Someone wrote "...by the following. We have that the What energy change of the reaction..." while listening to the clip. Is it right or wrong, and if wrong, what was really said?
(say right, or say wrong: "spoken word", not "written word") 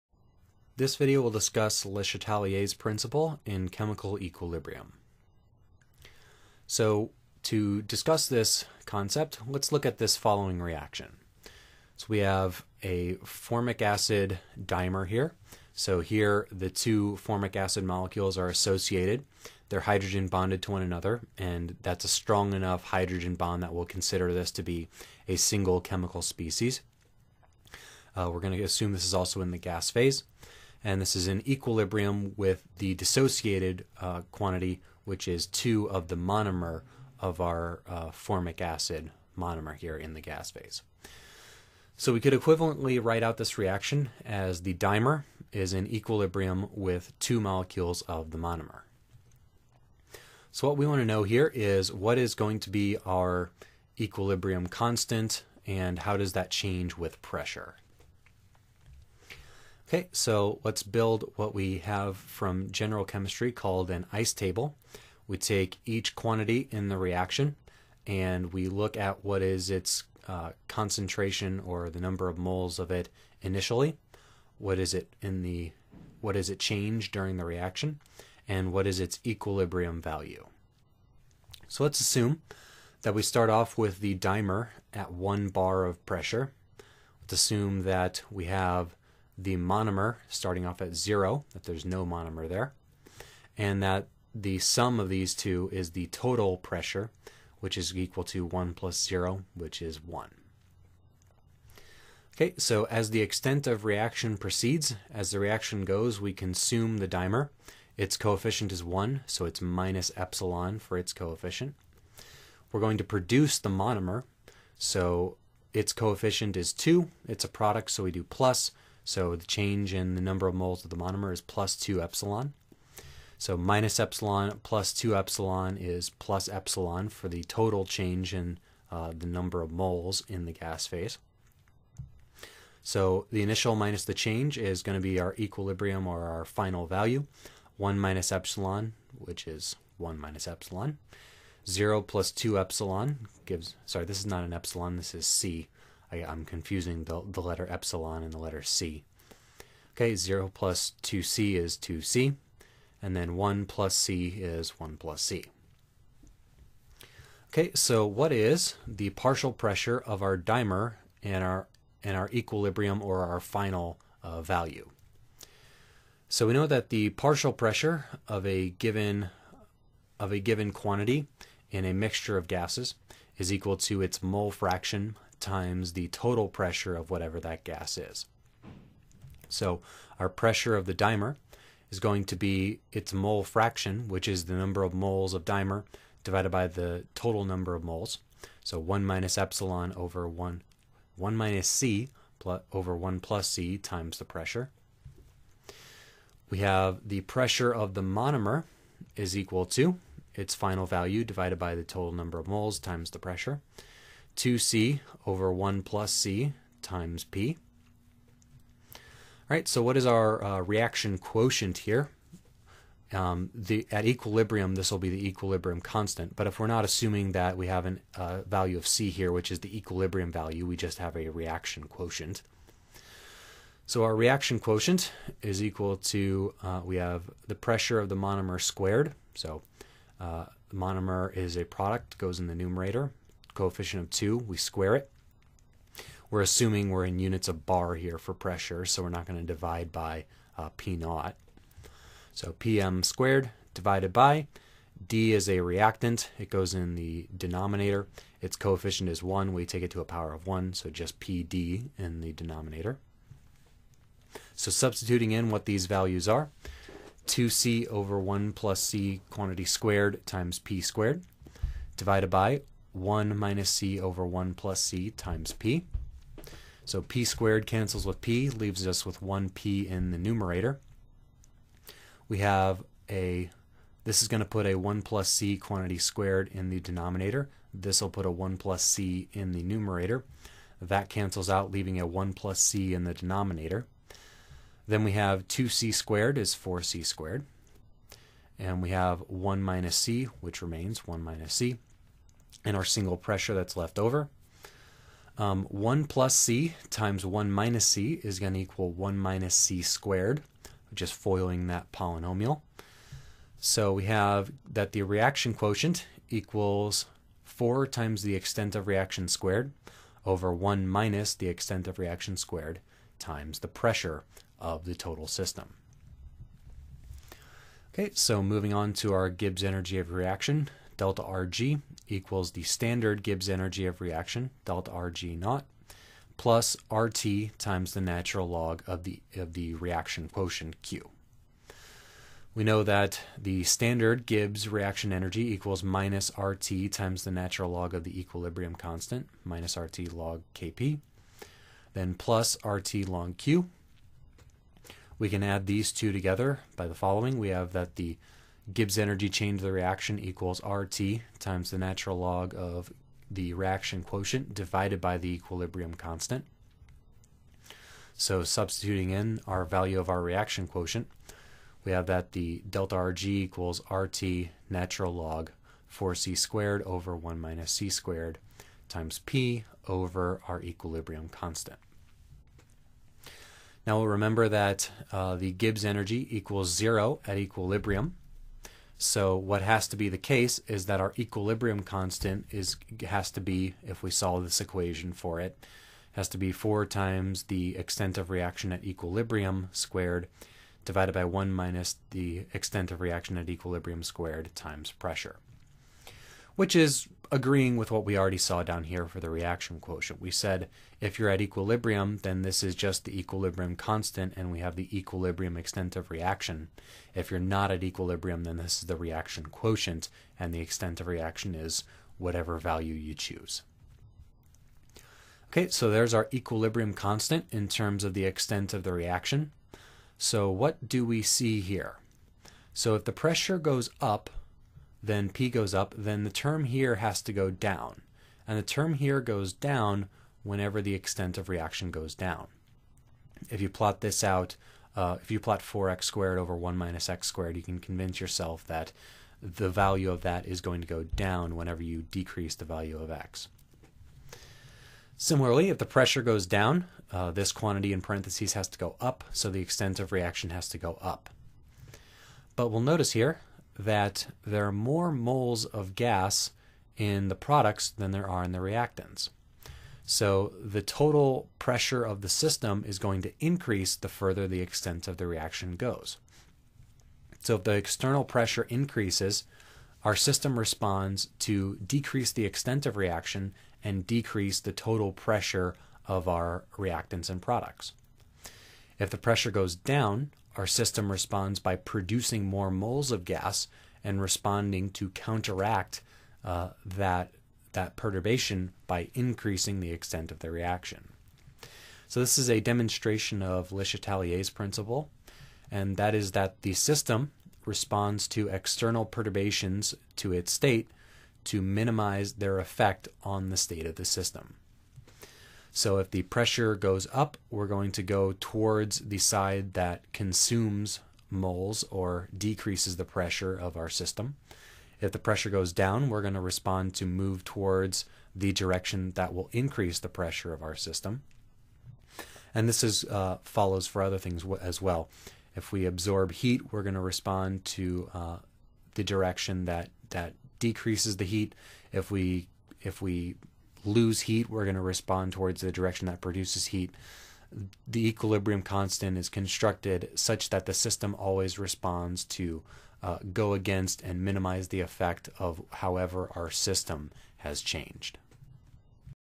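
wrong: "Gibbs", not "What".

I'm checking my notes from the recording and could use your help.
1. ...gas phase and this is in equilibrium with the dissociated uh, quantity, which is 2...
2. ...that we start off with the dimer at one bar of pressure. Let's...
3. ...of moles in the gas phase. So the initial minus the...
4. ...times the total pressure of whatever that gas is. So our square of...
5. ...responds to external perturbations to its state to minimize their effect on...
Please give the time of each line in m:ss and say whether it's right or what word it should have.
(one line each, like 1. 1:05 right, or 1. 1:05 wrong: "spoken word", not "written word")
1. 0:29 right
2. 1:23 right
3. 2:09 right
4. 2:55 wrong: "pressure", not "square"
5. 8:17 right.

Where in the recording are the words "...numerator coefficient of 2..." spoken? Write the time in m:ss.
3:52.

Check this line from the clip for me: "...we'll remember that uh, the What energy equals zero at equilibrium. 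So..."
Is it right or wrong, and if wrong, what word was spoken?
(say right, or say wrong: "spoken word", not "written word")
wrong: "Gibbs", not "What".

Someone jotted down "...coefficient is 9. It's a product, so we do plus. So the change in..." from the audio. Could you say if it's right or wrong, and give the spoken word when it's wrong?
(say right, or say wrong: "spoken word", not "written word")
wrong: "2", not "9".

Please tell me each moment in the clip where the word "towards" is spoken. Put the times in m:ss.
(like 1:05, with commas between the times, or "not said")
8:28, 8:37, 8:55.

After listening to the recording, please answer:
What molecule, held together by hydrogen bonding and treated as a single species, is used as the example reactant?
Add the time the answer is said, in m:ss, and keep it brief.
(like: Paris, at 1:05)
Formic acid dimer, at 0:13.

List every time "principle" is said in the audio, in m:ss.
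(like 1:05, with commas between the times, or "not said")
0:02, 8:14.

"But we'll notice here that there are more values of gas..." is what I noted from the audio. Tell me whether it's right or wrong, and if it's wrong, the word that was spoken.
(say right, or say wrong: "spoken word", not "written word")
wrong: "moles", not "values".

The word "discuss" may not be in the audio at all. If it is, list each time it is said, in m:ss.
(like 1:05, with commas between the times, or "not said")
0:01, 0:07.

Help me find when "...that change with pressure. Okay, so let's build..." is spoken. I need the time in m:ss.
0:56.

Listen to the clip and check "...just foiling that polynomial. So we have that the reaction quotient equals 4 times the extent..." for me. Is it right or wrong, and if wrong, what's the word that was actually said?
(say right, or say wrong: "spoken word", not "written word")
right.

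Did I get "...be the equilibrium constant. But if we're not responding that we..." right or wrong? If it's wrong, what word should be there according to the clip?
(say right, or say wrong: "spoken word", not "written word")
wrong: "assuming", not "responding".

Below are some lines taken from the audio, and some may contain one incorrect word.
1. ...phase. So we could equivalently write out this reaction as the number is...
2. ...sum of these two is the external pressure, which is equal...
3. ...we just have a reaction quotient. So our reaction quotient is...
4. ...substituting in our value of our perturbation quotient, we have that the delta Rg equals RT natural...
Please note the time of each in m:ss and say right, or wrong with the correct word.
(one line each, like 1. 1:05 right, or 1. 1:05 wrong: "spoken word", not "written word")
1. 0:40 wrong: "dimer", not "number"
2. 1:34 wrong: "total", not "external"
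3. 3:40 right
4. 5:58 wrong: "reaction", not "perturbation".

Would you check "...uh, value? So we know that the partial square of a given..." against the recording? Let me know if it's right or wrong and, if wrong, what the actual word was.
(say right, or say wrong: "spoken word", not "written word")
wrong: "pressure", not "square".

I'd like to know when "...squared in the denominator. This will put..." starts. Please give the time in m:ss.
4:35.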